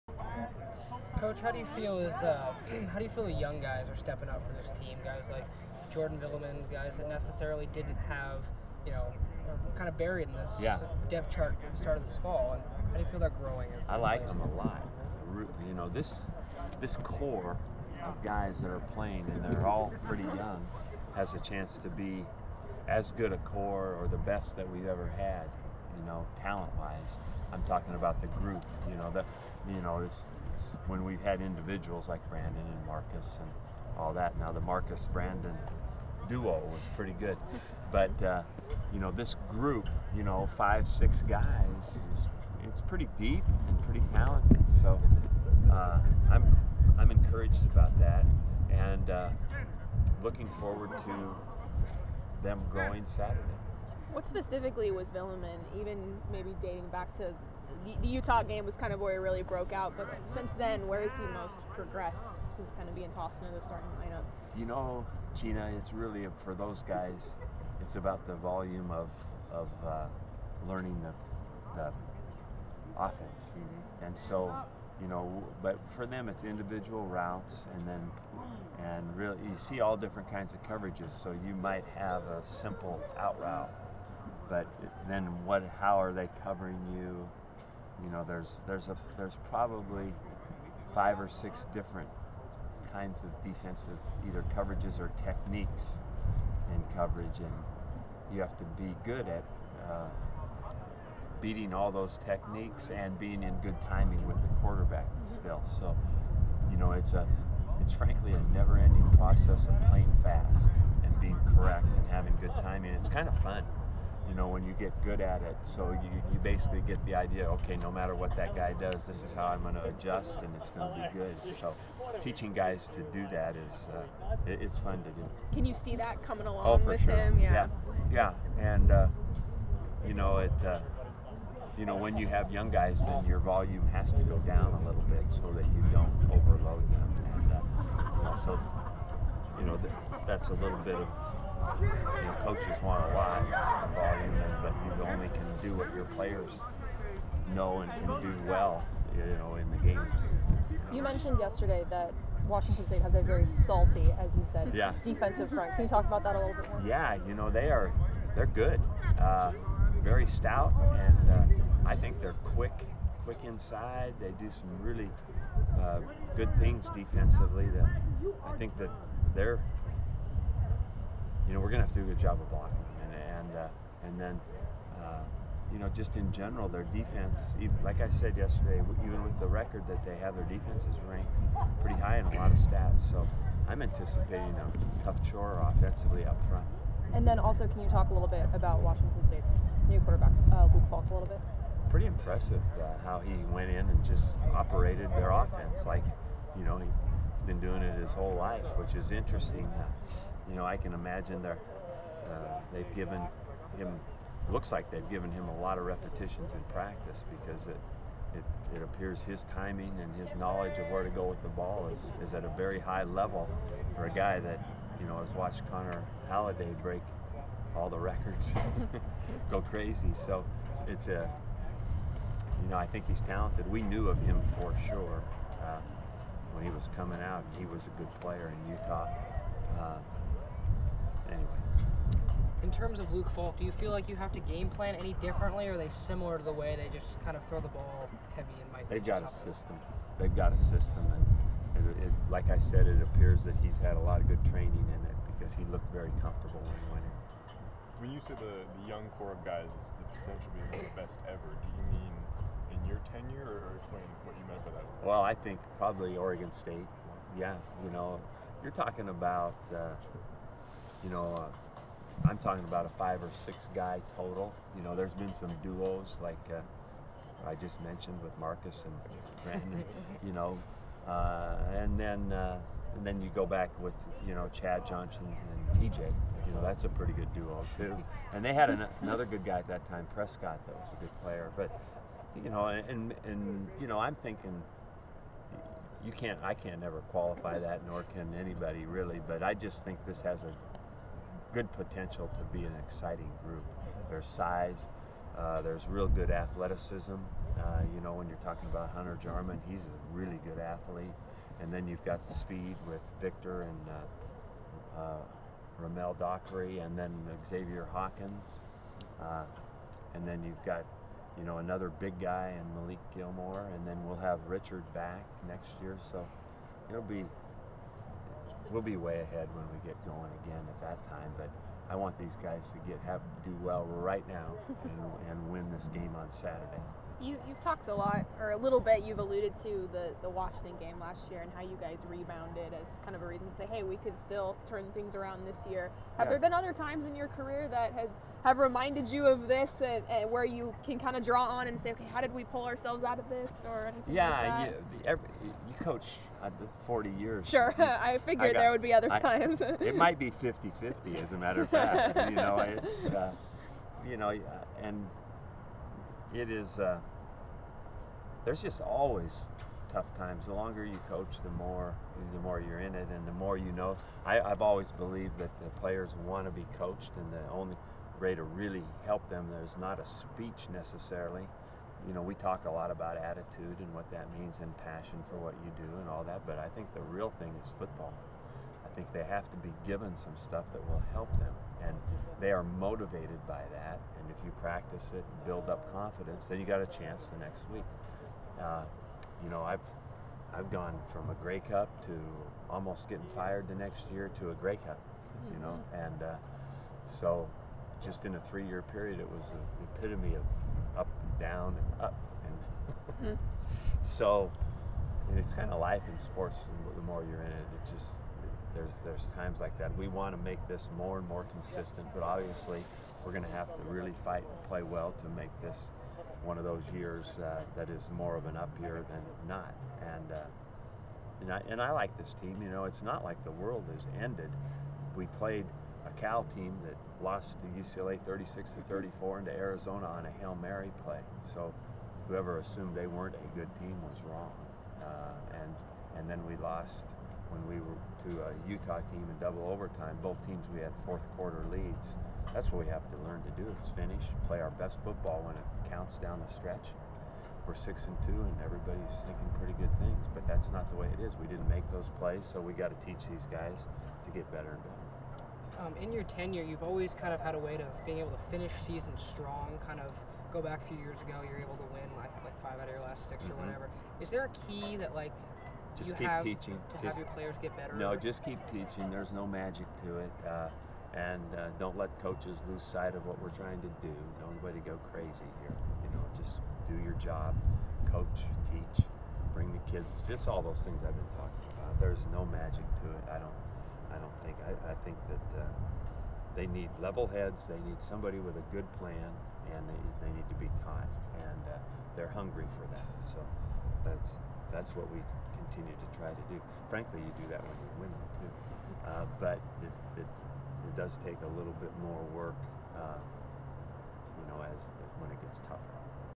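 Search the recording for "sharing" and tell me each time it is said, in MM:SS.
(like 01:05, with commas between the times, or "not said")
not said.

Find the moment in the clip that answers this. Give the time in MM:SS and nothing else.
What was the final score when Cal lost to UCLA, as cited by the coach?
07:08.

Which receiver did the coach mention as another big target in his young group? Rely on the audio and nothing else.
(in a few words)
Malik Gilmore.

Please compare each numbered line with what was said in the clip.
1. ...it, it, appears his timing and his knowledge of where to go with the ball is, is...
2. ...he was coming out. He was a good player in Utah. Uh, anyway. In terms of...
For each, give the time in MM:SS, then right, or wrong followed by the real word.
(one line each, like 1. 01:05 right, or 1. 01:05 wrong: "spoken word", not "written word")
1. 03:28 right
2. 03:46 right.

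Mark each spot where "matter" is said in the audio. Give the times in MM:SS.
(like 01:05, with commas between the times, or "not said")
01:57, 05:51.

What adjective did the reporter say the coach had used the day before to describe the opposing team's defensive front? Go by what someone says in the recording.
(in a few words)
Salty.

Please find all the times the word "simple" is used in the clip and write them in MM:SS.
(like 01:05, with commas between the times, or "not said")
01:22.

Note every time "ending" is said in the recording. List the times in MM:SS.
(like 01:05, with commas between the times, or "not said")
01:48.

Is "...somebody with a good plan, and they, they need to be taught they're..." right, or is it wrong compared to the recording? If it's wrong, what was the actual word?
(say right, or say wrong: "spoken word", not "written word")
right.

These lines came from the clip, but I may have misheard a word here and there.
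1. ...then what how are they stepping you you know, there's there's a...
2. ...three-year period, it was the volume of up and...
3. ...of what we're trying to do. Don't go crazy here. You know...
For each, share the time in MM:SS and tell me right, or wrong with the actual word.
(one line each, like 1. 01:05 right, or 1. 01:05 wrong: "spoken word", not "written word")
1. 01:25 wrong: "covering", not "stepping"
2. 06:38 wrong: "epitome", not "volume"
3. 07:53 right.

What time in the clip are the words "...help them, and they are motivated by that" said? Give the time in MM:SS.
06:21.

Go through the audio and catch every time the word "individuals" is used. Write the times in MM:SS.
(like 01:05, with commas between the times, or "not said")
00:31, 01:16.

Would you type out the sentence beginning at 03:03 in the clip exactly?
So I'm anticipating a tough chore offensively up front.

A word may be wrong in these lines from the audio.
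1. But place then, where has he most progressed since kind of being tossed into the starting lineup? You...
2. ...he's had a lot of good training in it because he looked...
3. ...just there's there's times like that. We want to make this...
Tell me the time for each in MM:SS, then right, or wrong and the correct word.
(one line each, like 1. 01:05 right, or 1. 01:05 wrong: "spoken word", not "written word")
1. 00:59 wrong: "since", not "place"
2. 04:03 right
3. 06:47 right.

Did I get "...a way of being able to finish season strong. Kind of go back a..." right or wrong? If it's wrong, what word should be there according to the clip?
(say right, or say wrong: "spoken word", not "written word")
right.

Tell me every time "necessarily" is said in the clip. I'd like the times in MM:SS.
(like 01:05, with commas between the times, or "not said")
00:07, 06:10.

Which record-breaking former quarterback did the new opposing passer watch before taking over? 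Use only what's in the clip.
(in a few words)
Connor Halliday.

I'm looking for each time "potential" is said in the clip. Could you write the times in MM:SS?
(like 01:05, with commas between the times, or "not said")
04:10, 04:51.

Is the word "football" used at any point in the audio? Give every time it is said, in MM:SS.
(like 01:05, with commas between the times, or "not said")
06:17, 07:25.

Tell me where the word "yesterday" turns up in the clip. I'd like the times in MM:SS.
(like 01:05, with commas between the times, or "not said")
02:31, 02:58.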